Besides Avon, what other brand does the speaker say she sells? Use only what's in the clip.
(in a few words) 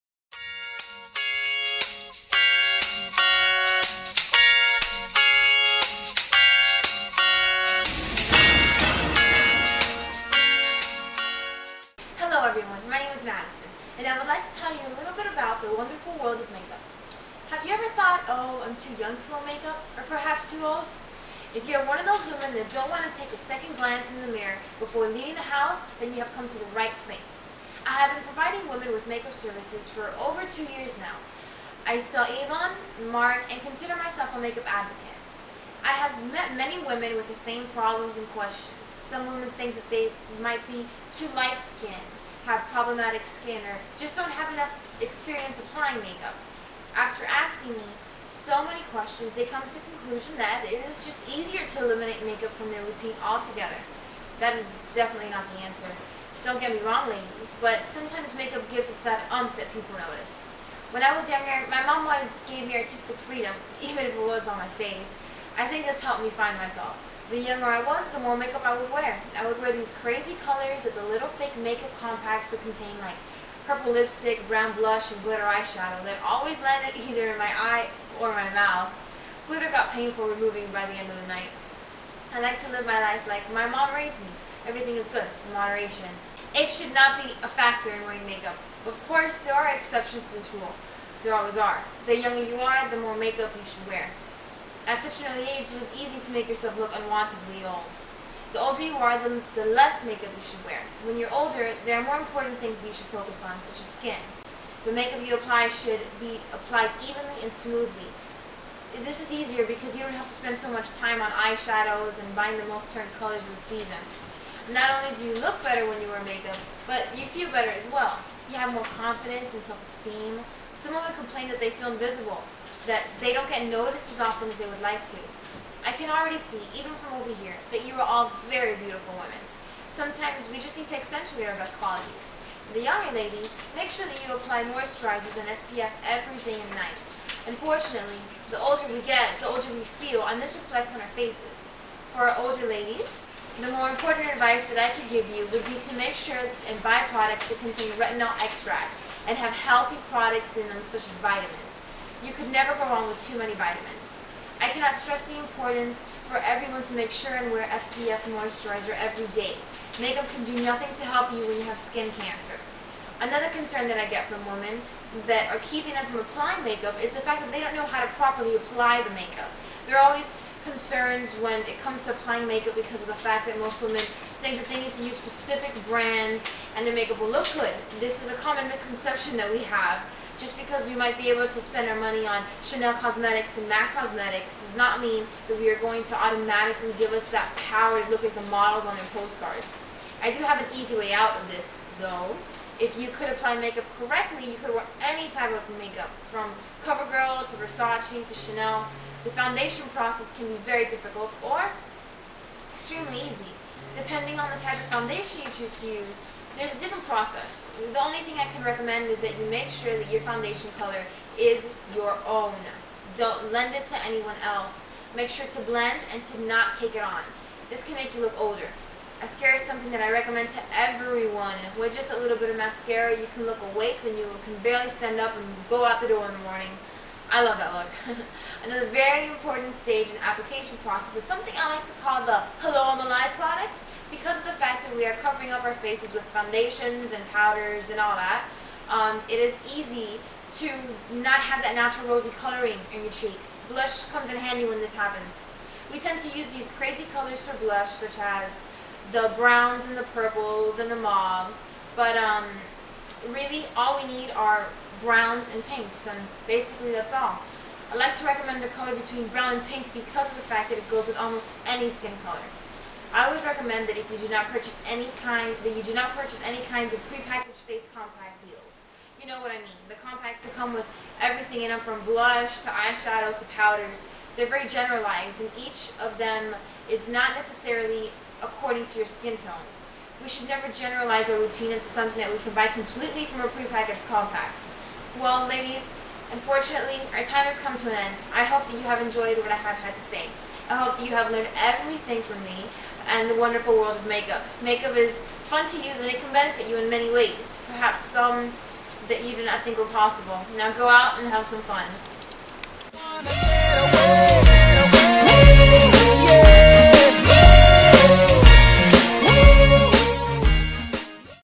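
Mark.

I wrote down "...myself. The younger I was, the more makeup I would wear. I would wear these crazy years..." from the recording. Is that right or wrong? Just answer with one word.
wrong.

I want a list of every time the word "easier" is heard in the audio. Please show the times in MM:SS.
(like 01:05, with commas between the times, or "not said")
00:51, 01:49.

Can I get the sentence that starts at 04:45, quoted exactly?
Well, ladies, unfortunately, our time has come to an end.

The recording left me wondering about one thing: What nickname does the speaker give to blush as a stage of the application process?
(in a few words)
Hello I'm Alive product.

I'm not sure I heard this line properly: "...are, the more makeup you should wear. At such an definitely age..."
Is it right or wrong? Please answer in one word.
wrong.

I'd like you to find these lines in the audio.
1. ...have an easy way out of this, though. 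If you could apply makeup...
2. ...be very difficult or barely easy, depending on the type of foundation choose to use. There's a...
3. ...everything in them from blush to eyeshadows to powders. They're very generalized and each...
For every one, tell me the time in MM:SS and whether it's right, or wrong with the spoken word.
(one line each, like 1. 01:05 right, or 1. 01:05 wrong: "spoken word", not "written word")
1. 03:10 right
2. 03:20 wrong: "extremely", not "barely"
3. 04:31 right.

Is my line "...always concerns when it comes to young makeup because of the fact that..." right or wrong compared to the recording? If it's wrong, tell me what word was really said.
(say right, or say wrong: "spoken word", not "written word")
wrong: "applying", not "young".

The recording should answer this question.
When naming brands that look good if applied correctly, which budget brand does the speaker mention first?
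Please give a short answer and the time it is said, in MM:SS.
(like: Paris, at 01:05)
CoverGirl, at 03:16.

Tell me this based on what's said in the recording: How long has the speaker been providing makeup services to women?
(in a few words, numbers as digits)
over 2 years.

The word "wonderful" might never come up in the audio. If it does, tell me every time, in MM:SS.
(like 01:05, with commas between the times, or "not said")
00:15, 04:53.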